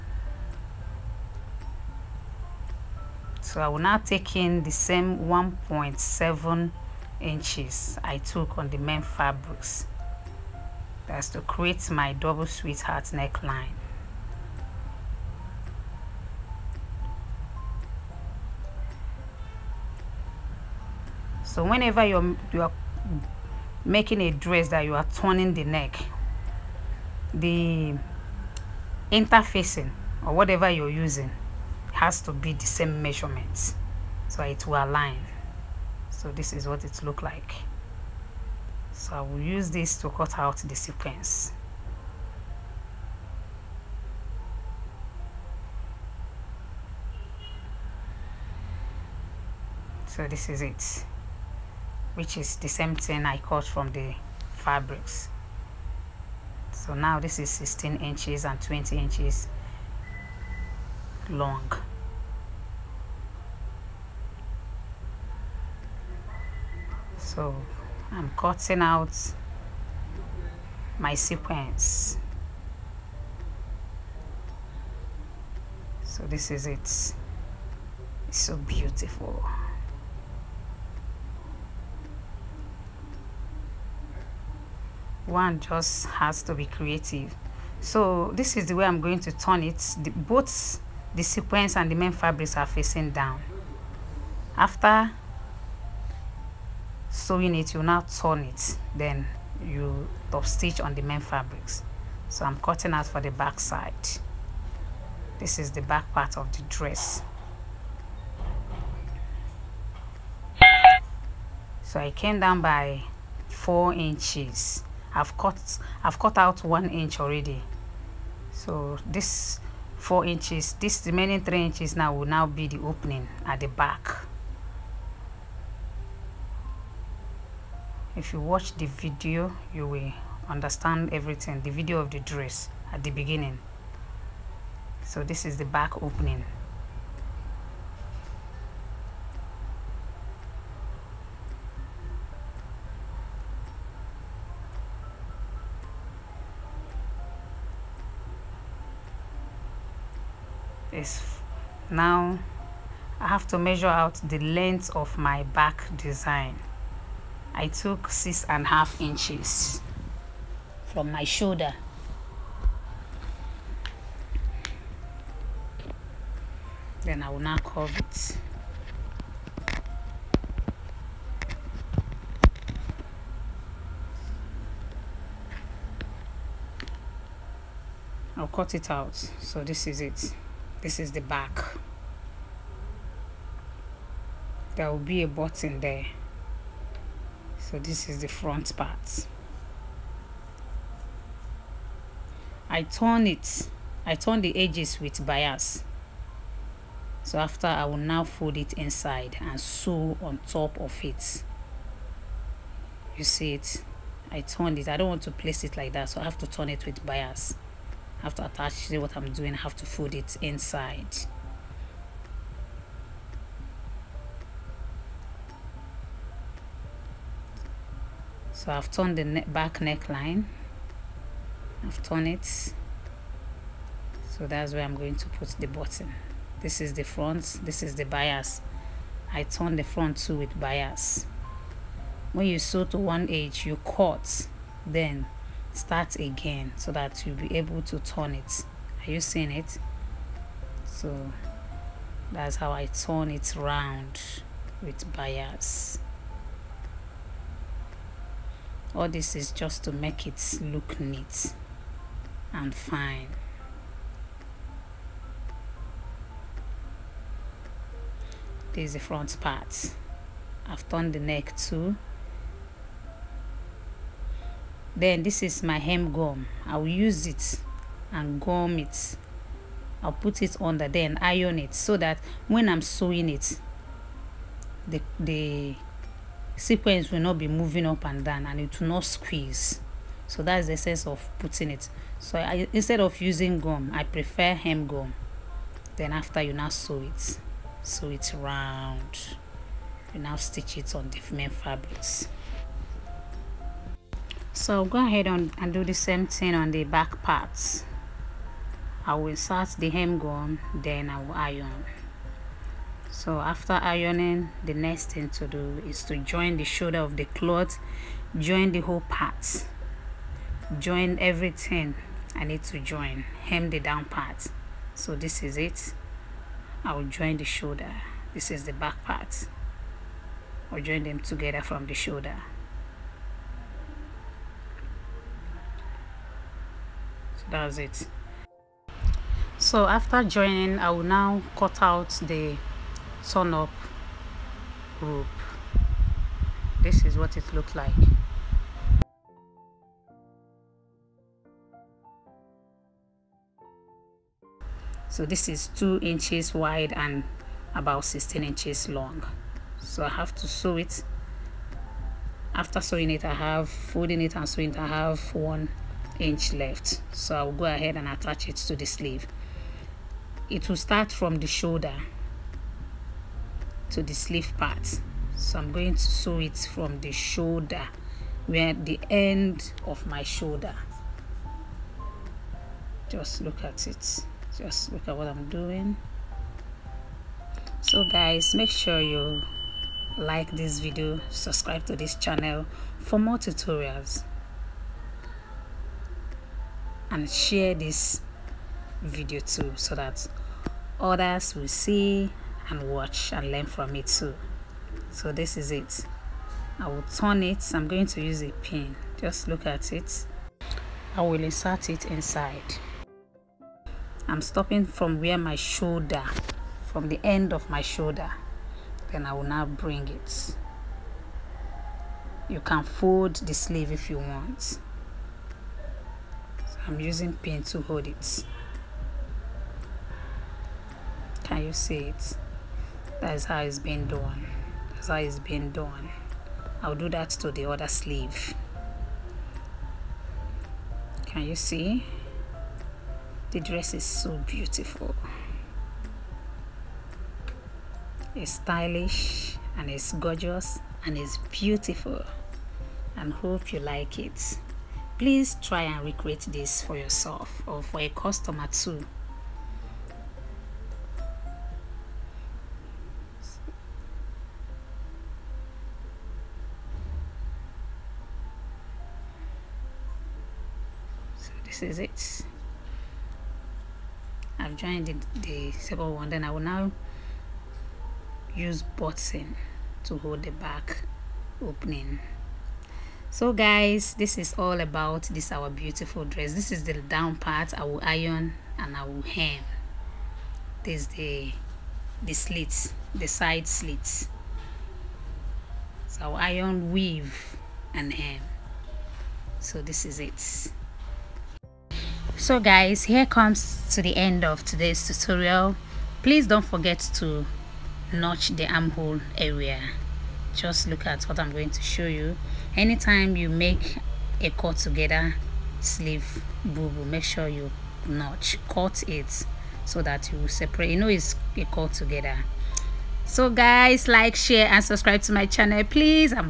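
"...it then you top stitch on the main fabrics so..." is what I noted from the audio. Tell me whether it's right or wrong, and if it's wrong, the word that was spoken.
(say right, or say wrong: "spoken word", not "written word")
right.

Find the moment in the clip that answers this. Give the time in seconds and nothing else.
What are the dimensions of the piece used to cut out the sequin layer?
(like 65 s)
57 s.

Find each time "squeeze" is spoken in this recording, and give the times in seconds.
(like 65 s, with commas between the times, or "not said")
279 s.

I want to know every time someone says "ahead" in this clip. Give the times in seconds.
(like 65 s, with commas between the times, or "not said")
295 s, 357 s.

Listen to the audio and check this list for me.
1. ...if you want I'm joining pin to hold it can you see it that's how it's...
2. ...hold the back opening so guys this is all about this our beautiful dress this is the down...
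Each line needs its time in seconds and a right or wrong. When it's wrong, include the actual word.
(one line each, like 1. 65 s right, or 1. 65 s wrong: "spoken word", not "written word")
1. 413 s wrong: "using", not "joining"
2. 470 s right.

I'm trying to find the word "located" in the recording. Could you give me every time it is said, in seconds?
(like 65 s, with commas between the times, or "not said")
not said.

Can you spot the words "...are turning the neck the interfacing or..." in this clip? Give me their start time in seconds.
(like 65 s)
24 s.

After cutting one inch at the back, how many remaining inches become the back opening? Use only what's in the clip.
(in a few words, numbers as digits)
3 inches.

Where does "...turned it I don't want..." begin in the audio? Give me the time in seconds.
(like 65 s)
204 s.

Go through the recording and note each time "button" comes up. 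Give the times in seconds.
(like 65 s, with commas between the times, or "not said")
185 s, 225 s, 468 s.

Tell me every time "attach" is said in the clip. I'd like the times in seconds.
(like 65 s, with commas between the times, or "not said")
208 s, 358 s.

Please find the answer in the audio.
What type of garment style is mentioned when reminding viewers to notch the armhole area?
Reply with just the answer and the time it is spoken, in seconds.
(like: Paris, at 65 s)
cut together sleeve bubu, at 504 s.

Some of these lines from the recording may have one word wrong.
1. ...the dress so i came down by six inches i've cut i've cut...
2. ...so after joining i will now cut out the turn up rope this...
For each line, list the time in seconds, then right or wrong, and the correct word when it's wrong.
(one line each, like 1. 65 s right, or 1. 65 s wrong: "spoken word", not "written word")
1. 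106 s wrong: "four", not "six"
2. 329 s right.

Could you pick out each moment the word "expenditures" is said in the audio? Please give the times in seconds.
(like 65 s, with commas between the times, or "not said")
not said.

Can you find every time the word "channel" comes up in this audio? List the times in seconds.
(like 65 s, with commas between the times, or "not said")
382 s, 515 s.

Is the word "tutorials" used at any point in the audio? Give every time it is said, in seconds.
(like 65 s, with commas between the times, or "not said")
383 s, 495 s.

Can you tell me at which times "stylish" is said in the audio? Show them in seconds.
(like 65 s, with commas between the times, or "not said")
438 s.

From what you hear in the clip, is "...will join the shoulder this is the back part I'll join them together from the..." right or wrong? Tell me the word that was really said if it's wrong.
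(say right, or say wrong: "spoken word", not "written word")
right.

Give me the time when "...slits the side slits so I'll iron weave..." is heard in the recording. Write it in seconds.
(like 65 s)
482 s.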